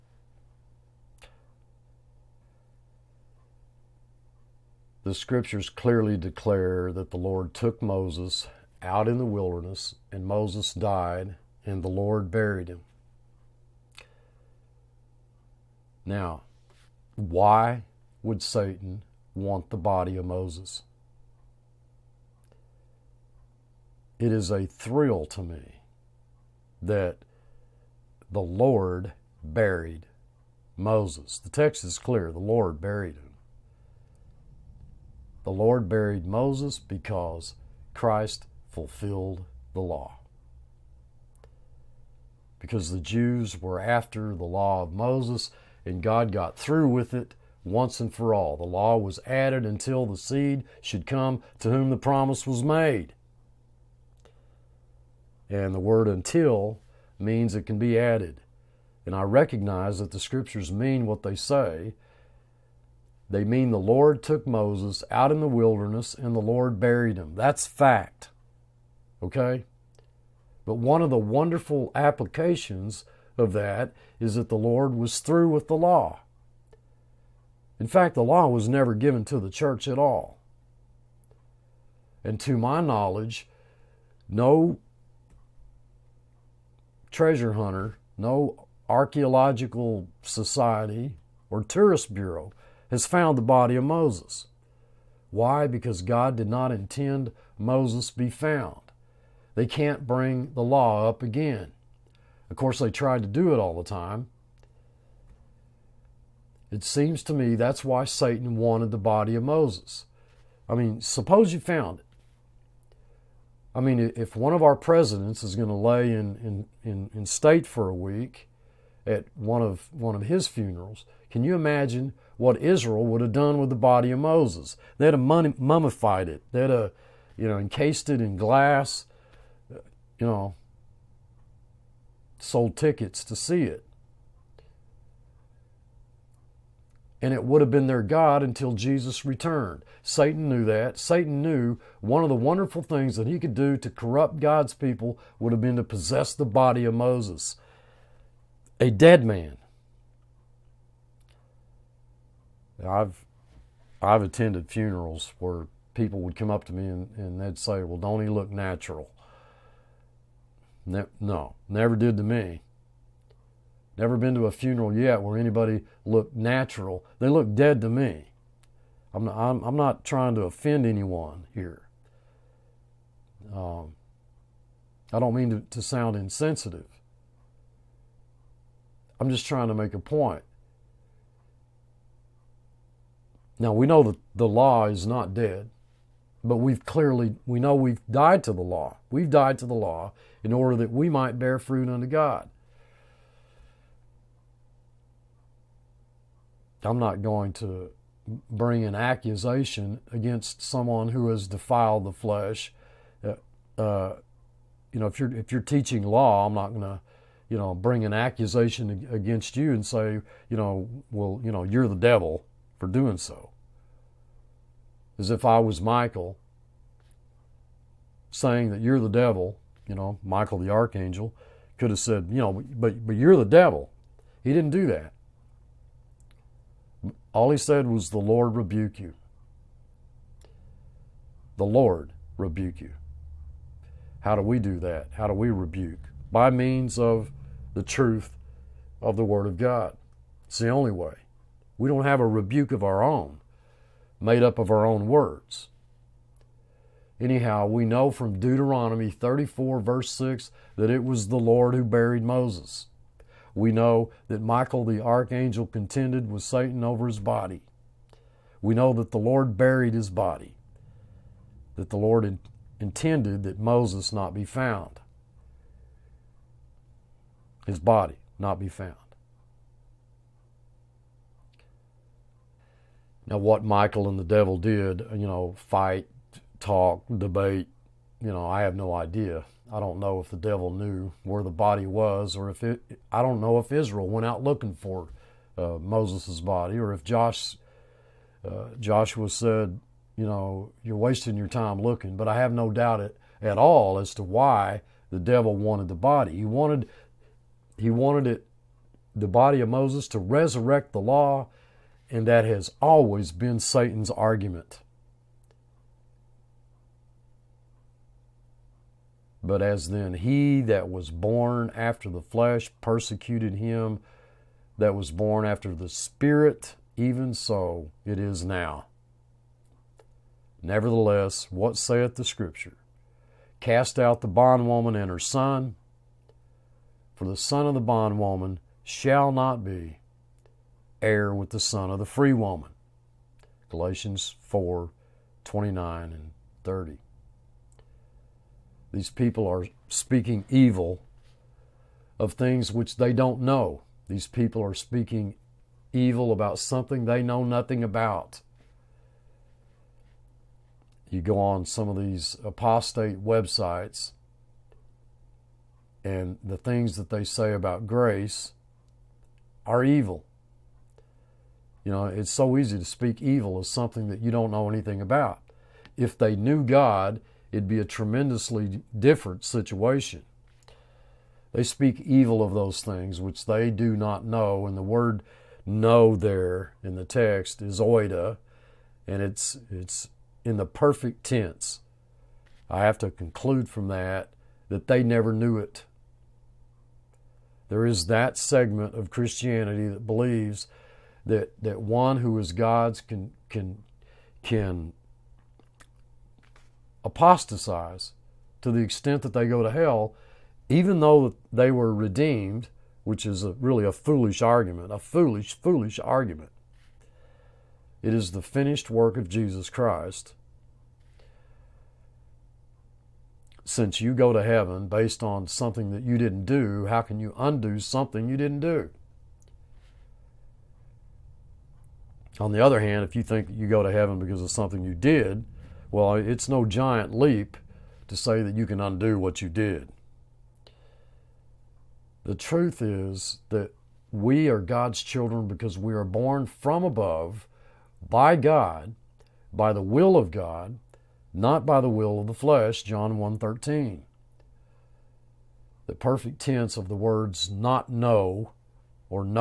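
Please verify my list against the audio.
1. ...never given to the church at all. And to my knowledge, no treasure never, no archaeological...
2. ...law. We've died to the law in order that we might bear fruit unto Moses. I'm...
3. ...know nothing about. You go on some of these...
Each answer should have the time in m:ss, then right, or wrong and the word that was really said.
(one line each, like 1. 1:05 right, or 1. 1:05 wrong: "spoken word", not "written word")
1. 1:18 wrong: "hunter", not "never"
2. 3:08 wrong: "God", not "Moses"
3. 5:47 right.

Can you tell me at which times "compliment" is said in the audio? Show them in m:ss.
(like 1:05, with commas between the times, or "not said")
not said.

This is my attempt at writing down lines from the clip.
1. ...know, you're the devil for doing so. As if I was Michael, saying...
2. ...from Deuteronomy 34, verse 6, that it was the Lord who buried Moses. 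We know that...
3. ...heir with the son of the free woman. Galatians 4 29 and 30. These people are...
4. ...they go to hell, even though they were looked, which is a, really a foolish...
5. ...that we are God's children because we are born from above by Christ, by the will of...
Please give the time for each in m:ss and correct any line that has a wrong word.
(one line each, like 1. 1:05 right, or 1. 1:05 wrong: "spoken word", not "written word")
1. 3:31 right
2. 4:08 right
3. 5:31 right
4. 6:39 wrong: "redeemed", not "looked"
5. 7:13 wrong: "God", not "Christ".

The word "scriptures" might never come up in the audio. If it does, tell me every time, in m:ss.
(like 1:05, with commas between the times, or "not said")
0:05, 1:00, 5:22.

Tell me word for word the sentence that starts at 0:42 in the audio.
Because the Jews were after the law of Moses and God got through with it once and for all.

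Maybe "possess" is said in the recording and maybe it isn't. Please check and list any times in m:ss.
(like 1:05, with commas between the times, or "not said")
2:25.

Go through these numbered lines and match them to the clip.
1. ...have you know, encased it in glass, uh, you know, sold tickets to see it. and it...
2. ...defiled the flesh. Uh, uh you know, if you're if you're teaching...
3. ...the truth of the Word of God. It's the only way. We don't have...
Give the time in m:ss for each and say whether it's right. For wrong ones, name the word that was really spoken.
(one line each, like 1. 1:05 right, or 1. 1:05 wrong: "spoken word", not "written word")
1. 2:06 right
2. 3:21 right
3. 3:57 right.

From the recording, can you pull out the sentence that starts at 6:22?
I have to conclude from that that they never knew it.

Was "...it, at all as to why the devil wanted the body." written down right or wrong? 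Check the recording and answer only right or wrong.
right.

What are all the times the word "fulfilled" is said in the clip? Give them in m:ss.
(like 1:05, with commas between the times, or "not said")
0:38.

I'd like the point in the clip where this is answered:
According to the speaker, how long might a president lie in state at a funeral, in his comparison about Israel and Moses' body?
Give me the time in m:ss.
1:57.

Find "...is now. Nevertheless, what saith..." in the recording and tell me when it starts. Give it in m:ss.
5:18.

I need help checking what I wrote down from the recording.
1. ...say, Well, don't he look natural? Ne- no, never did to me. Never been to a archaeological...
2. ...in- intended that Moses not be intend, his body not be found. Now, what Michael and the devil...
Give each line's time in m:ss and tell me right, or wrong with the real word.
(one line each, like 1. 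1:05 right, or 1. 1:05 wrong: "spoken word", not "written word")
1. 2:37 wrong: "funeral", not "archaeological"
2. 4:22 wrong: "found", not "intend".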